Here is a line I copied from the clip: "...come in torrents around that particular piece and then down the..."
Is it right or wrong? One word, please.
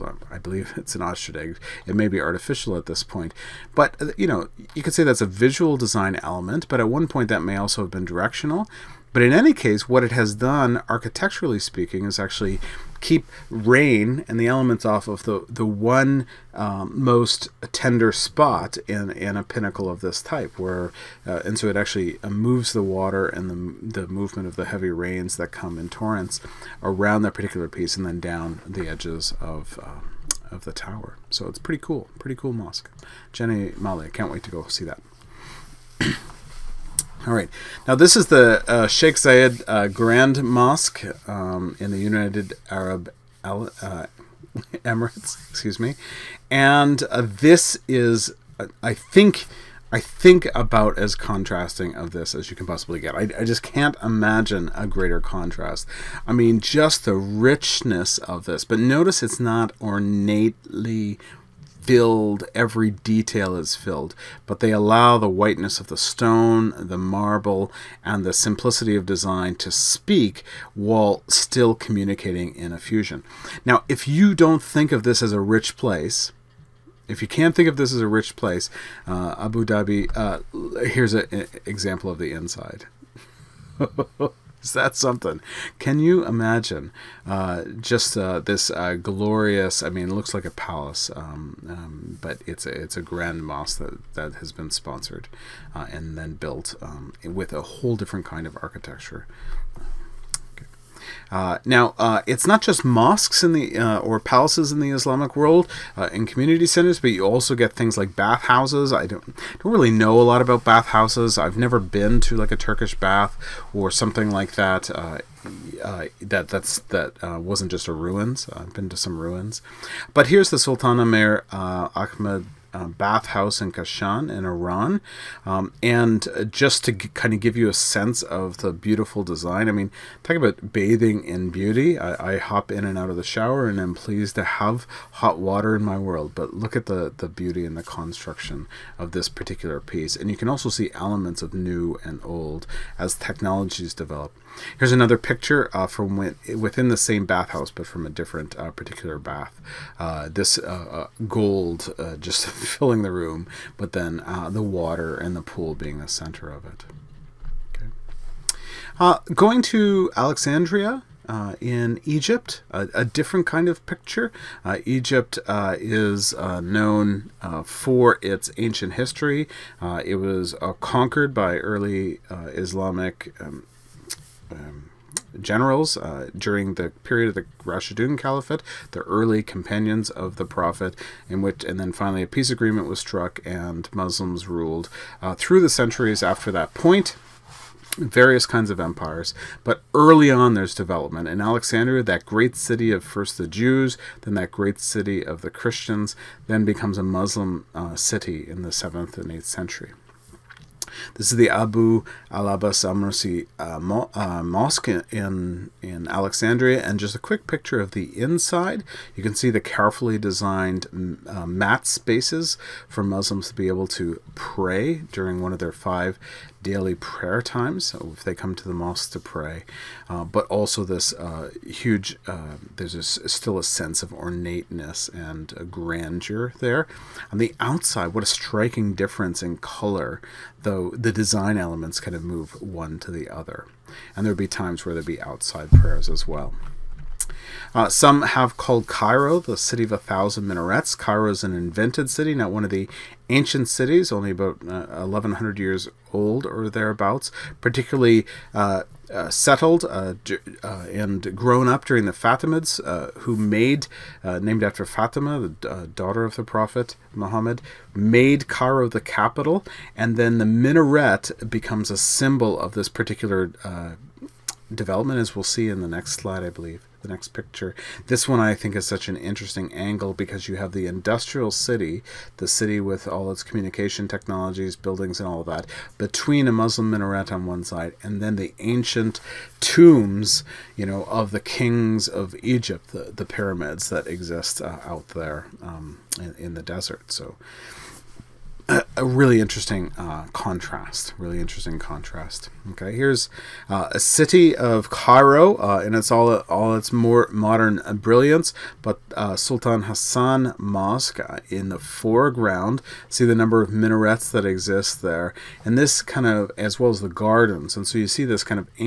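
right.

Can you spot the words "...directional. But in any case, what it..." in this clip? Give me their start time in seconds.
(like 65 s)
8 s.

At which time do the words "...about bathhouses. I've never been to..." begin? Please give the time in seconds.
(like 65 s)
110 s.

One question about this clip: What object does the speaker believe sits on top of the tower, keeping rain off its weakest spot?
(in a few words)
An ostrich egg.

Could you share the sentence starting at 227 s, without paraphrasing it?
On the outside, what a striking difference in color, though the design elements kind of move one to the other.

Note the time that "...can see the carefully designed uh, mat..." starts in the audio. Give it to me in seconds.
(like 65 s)
209 s.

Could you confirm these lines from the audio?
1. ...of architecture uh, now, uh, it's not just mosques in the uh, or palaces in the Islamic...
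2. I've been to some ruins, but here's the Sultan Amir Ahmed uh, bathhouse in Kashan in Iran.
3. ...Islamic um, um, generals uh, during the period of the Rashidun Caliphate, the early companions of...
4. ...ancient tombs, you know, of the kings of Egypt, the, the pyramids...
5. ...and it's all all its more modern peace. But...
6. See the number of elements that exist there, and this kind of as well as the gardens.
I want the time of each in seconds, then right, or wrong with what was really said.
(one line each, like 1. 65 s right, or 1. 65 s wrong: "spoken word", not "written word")
1. 98 s right
2. 118 s right
3. 172 s right
4. 278 s right
5. 295 s wrong: "brilliance", not "peace"
6. 303 s wrong: "minarets", not "elements".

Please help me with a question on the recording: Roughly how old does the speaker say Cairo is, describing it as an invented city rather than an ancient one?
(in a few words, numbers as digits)
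About 1100 years.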